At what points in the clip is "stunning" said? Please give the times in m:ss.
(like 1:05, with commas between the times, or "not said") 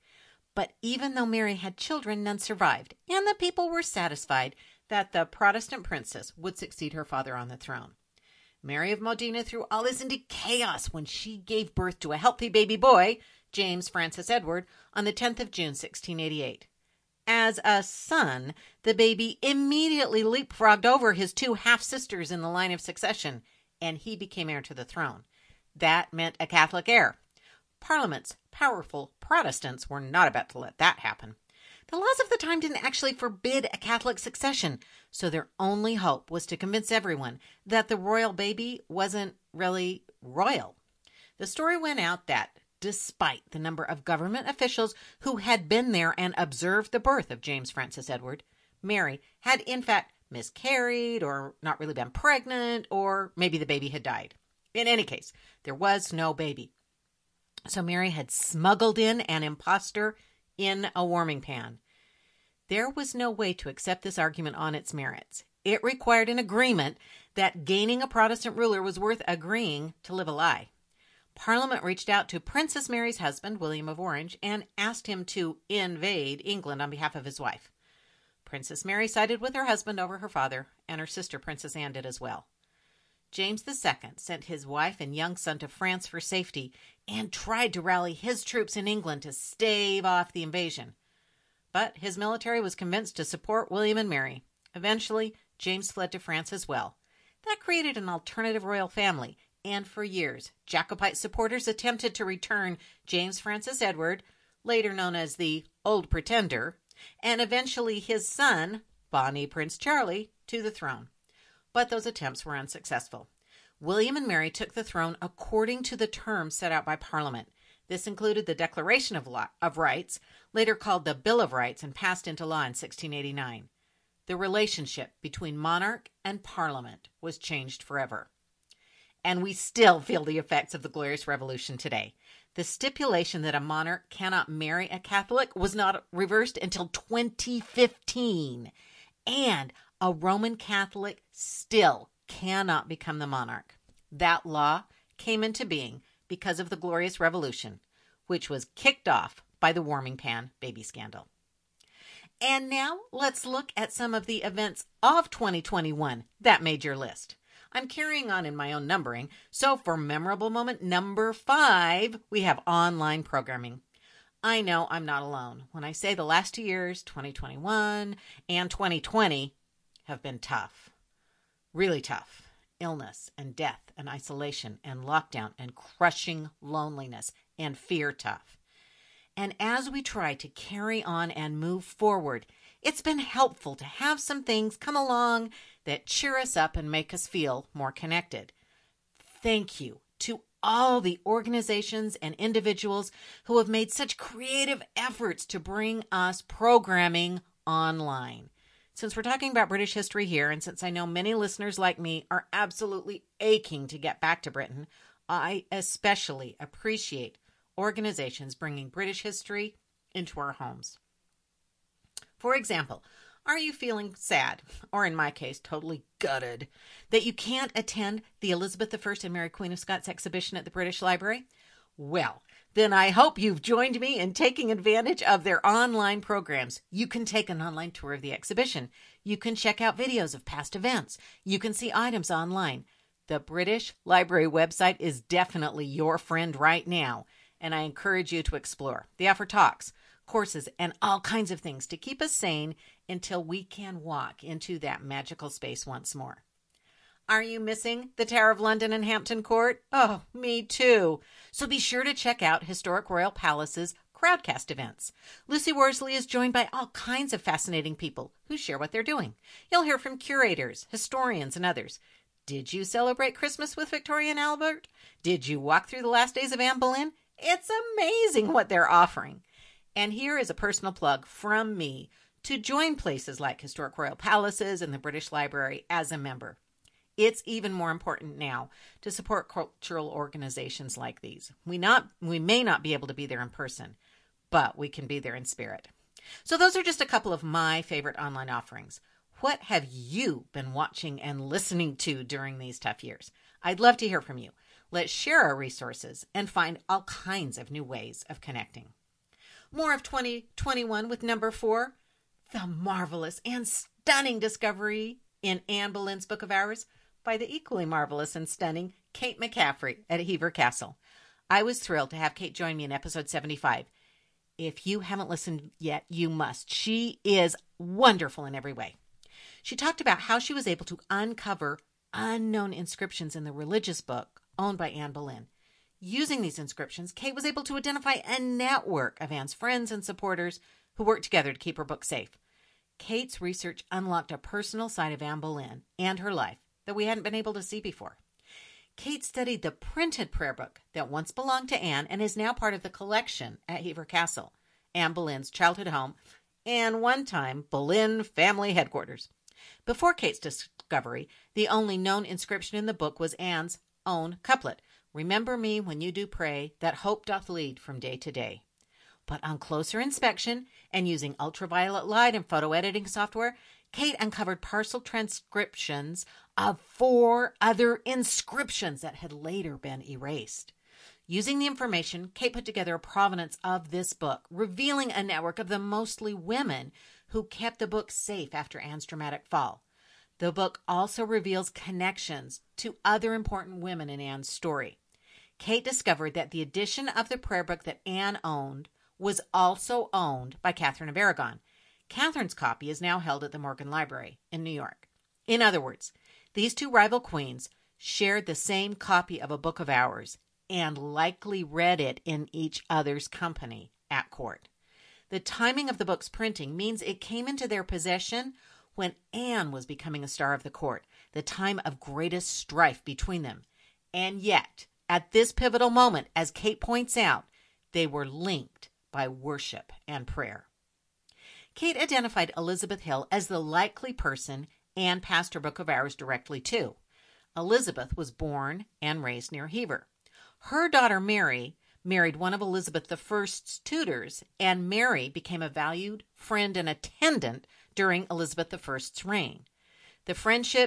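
5:03, 5:08.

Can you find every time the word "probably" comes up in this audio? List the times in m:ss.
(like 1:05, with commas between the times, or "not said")
not said.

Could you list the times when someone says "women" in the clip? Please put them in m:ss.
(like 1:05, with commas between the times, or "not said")
6:16, 6:23.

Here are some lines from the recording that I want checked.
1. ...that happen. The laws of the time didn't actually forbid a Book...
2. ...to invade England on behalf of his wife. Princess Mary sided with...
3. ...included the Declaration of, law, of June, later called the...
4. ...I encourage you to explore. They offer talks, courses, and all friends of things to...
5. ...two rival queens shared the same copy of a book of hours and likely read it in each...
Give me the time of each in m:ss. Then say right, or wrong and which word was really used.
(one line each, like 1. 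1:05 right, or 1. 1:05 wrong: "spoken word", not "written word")
1. 0:30 wrong: "Catholic", not "Book"
2. 1:15 right
3. 1:58 wrong: "Rights", not "June"
4. 3:57 wrong: "kinds", not "friends"
5. 6:36 right.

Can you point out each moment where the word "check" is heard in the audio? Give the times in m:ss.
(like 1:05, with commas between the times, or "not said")
3:49, 4:12.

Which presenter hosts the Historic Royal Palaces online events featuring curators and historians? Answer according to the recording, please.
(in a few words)
Lucy Worsley.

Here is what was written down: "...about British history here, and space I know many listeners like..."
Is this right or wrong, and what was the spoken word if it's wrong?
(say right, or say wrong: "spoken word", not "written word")
wrong: "since", not "space".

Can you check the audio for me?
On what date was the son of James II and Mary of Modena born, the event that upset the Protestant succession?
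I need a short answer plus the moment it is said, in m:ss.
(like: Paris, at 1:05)
10th of June, 1688, at 0:15.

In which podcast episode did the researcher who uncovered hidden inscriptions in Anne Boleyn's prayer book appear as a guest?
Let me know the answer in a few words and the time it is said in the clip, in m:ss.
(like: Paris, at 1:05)
Episode 75, at 5:12.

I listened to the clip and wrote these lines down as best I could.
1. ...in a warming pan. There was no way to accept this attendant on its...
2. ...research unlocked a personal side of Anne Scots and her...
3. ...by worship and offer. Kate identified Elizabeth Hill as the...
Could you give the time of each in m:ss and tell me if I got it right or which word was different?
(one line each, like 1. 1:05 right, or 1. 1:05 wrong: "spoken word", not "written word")
1. 1:00 wrong: "argument", not "attendant"
2. 5:33 wrong: "Boleyn", not "Scots"
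3. 6:59 wrong: "prayer", not "offer".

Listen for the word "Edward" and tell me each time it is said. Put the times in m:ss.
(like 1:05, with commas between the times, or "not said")
0:14, 0:48, 1:43.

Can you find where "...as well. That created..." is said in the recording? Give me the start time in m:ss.
1:36.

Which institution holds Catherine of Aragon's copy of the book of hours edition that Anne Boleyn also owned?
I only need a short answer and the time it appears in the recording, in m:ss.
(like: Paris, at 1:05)
Morgan Library, at 6:33.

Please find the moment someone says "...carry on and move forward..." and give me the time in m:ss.
3:00.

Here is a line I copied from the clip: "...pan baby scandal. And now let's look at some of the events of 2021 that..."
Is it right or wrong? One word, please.
right.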